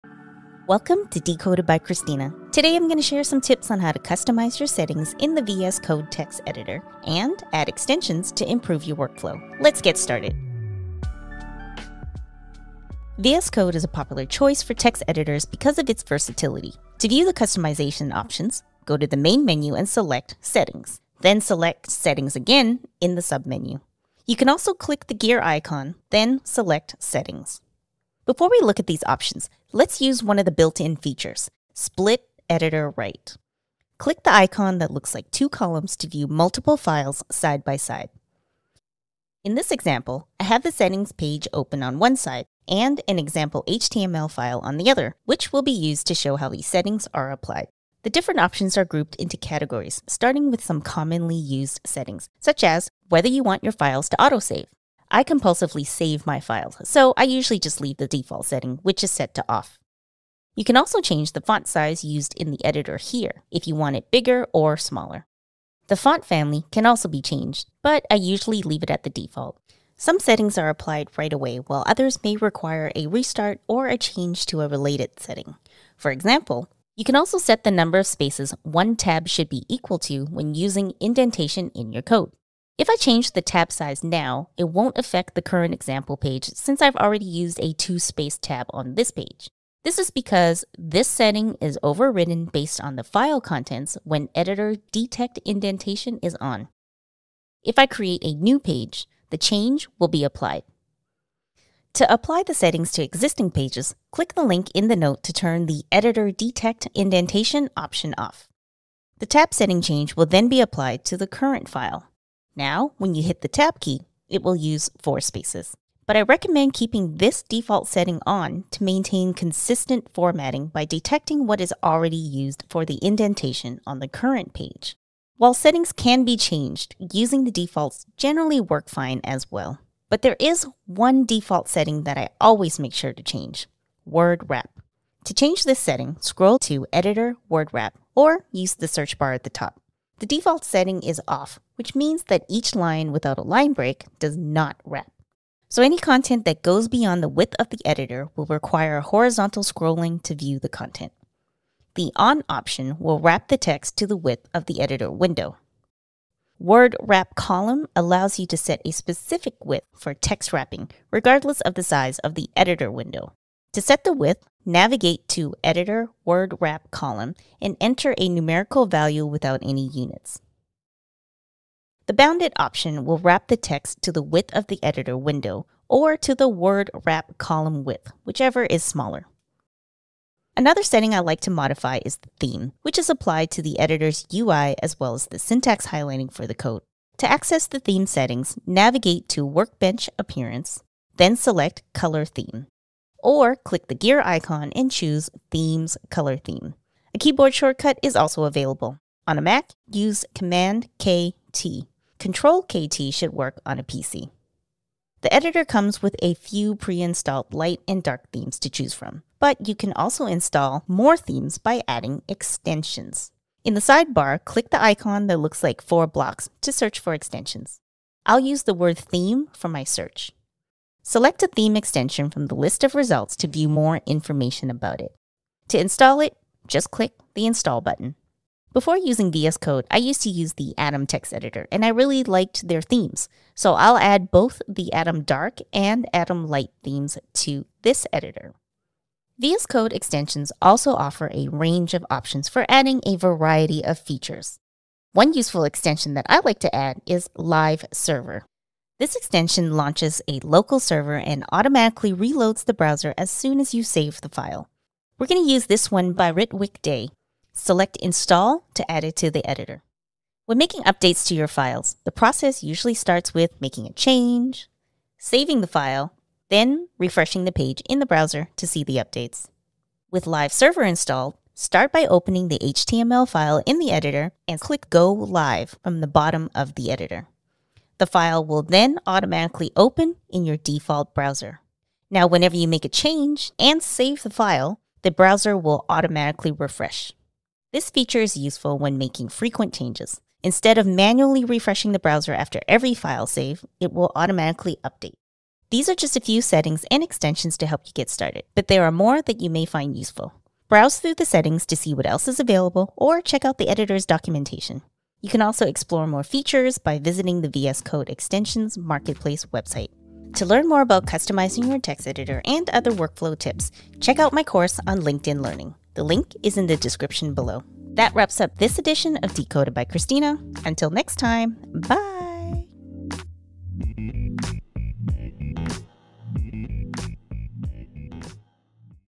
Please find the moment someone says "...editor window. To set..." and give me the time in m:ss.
2:42.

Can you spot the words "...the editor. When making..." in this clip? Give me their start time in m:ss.
4:19.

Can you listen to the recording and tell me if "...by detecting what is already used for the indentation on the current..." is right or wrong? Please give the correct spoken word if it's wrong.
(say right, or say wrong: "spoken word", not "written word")
right.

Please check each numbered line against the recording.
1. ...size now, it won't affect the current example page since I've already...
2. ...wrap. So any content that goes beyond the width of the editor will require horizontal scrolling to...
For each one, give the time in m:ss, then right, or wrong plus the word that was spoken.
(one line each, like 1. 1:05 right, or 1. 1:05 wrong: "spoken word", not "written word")
1. 1:23 right
2. 2:24 right.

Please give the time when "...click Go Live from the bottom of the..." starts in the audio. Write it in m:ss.
4:34.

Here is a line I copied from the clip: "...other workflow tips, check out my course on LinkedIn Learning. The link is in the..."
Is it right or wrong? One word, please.
right.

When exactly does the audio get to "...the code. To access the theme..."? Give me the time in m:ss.
3:06.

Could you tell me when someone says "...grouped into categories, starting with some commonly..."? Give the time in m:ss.
0:48.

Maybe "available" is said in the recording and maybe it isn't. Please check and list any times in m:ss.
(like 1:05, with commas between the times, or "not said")
3:18, 5:02.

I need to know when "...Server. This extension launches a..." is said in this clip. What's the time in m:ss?
4:07.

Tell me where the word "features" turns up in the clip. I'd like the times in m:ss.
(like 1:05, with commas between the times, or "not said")
0:30, 4:03, 4:47, 5:06.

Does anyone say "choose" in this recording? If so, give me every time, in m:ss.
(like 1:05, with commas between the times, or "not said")
3:14, 3:28.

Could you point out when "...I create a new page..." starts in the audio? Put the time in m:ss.
1:37.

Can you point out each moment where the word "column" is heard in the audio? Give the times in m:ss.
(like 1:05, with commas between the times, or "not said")
0:35, 2:37, 2:46, 2:57.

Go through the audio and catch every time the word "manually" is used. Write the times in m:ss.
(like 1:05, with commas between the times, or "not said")
4:50.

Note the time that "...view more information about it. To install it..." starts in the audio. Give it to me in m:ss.
3:43.